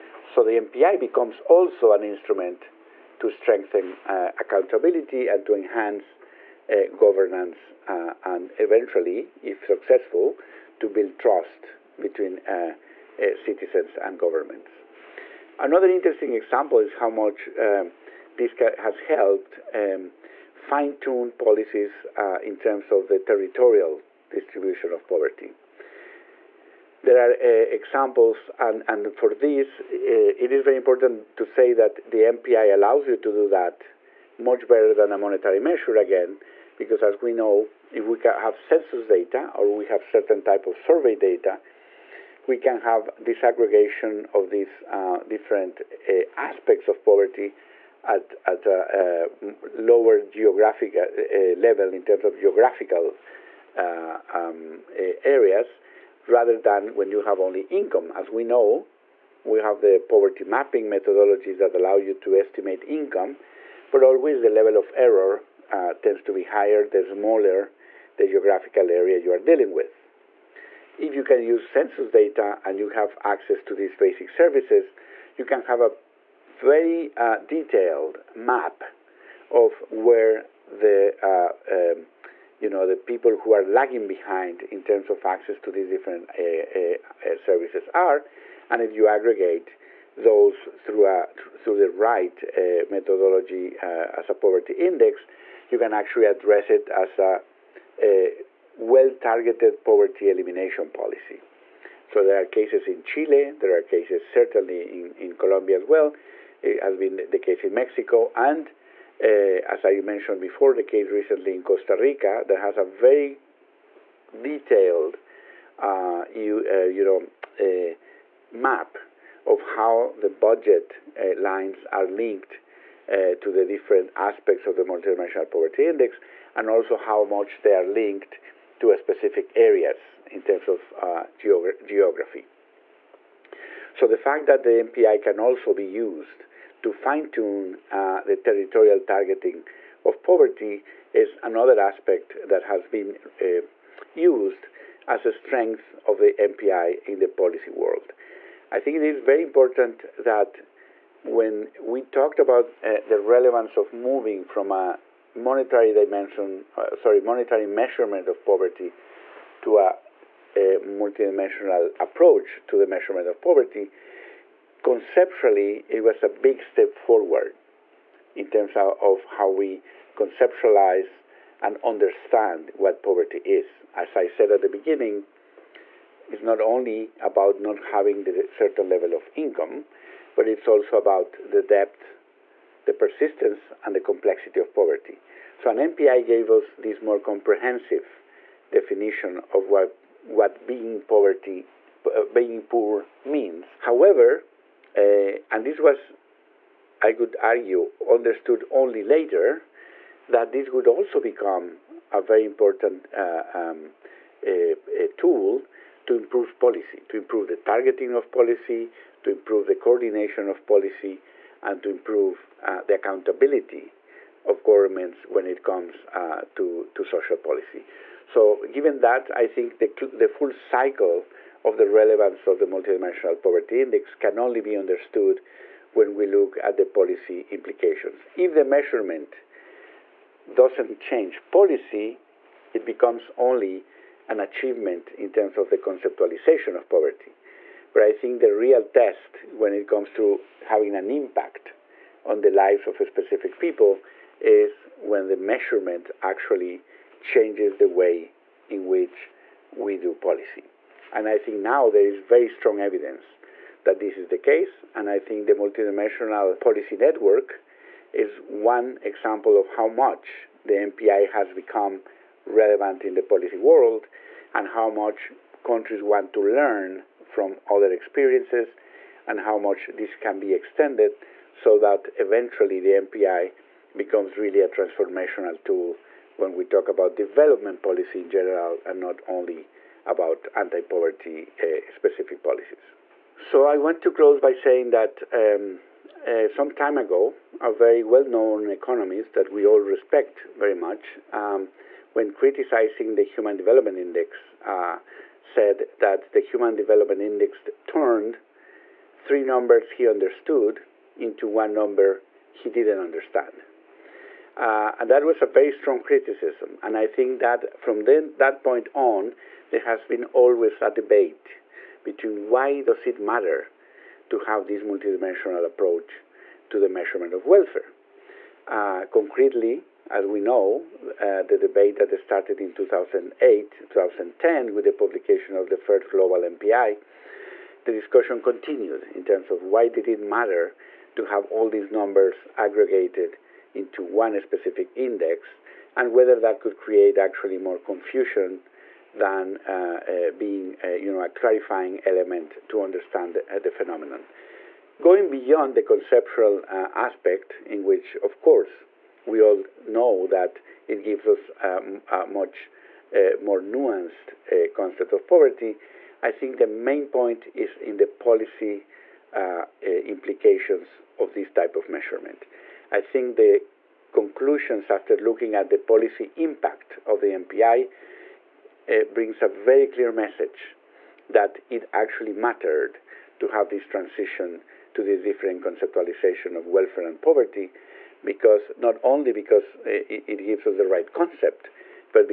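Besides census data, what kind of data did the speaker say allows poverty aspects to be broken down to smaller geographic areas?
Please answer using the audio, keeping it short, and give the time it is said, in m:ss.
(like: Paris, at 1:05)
survey data, at 0:40.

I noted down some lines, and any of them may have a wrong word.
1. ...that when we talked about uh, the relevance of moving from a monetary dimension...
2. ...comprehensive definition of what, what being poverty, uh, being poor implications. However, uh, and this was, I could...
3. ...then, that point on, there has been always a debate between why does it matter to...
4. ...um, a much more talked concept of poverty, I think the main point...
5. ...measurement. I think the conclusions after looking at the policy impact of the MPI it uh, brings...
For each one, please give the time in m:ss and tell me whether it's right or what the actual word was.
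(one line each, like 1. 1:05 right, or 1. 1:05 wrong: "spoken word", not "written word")
1. 2:30 right
2. 3:07 wrong: "means", not "implications"
3. 5:08 right
4. 5:51 wrong: "nuanced", not "talked"
5. 6:01 right.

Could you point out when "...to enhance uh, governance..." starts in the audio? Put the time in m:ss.
0:05.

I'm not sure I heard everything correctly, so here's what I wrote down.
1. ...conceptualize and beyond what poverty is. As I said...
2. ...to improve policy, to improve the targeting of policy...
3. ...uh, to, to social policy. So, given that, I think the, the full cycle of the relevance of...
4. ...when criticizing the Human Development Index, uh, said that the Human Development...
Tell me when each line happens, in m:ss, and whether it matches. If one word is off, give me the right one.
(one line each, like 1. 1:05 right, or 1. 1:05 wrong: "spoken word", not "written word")
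1. 2:50 wrong: "understand", not "beyond"
2. 3:26 right
3. 3:36 right
4. 4:52 right.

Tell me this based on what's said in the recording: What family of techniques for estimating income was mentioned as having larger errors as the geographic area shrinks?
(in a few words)
poverty mapping.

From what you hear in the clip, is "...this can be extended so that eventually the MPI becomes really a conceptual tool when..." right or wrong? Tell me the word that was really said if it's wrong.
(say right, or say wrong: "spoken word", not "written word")
wrong: "transformational", not "conceptual".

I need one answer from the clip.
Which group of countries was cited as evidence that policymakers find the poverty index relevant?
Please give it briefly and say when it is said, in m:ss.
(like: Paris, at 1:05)
multidimensional policy network, at 4:15.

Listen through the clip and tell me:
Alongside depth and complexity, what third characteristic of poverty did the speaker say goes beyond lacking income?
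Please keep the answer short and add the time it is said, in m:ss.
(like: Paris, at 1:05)
persistence, at 3:02.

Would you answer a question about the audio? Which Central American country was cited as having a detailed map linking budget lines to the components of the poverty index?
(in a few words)
Costa Rica.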